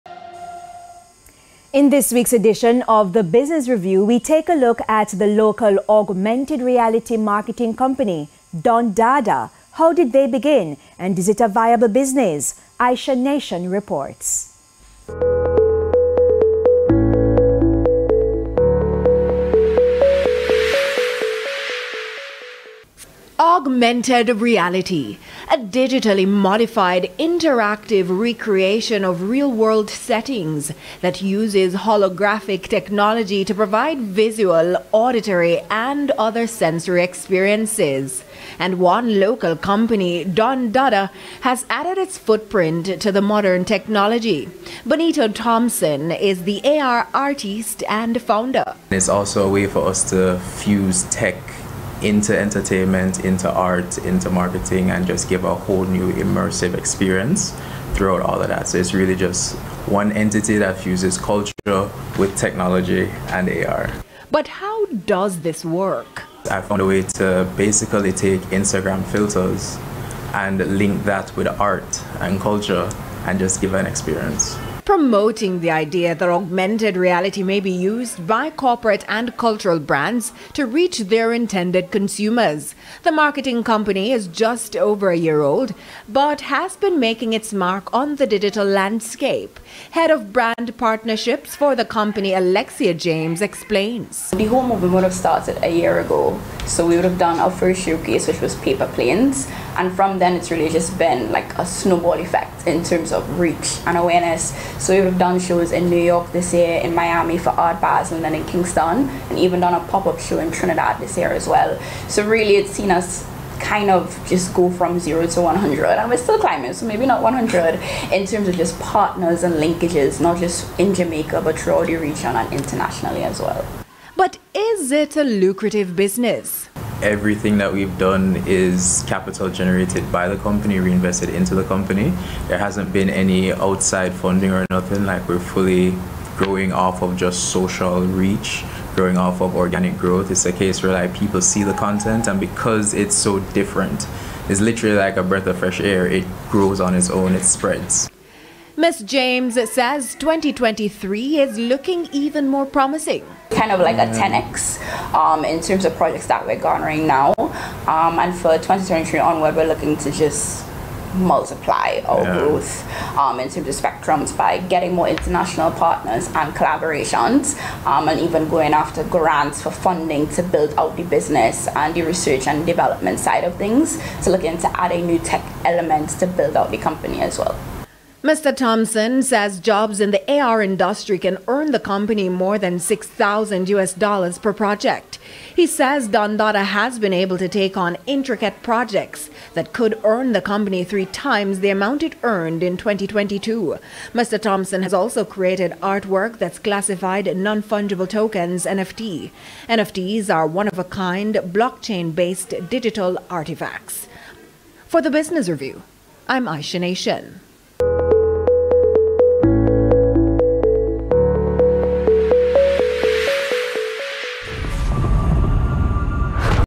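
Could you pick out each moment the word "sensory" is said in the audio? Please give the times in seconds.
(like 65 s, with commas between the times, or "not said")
36 s.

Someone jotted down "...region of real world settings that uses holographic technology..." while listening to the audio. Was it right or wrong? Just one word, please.
wrong.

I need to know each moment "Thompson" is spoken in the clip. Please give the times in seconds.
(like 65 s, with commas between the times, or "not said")
45 s, 178 s, 194 s.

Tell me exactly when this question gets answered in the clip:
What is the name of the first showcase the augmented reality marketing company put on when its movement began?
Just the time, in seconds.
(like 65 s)
98 s.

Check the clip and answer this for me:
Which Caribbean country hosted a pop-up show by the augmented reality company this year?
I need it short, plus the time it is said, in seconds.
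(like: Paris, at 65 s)
Trinidad, at 110 s.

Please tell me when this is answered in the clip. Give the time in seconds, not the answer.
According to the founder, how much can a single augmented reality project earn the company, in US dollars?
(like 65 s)
182 s.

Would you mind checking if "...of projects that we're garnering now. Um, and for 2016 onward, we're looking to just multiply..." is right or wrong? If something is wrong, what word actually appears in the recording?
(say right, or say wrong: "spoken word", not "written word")
wrong: "2023", not "2016".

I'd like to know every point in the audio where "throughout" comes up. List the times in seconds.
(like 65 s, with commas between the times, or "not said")
57 s, 121 s.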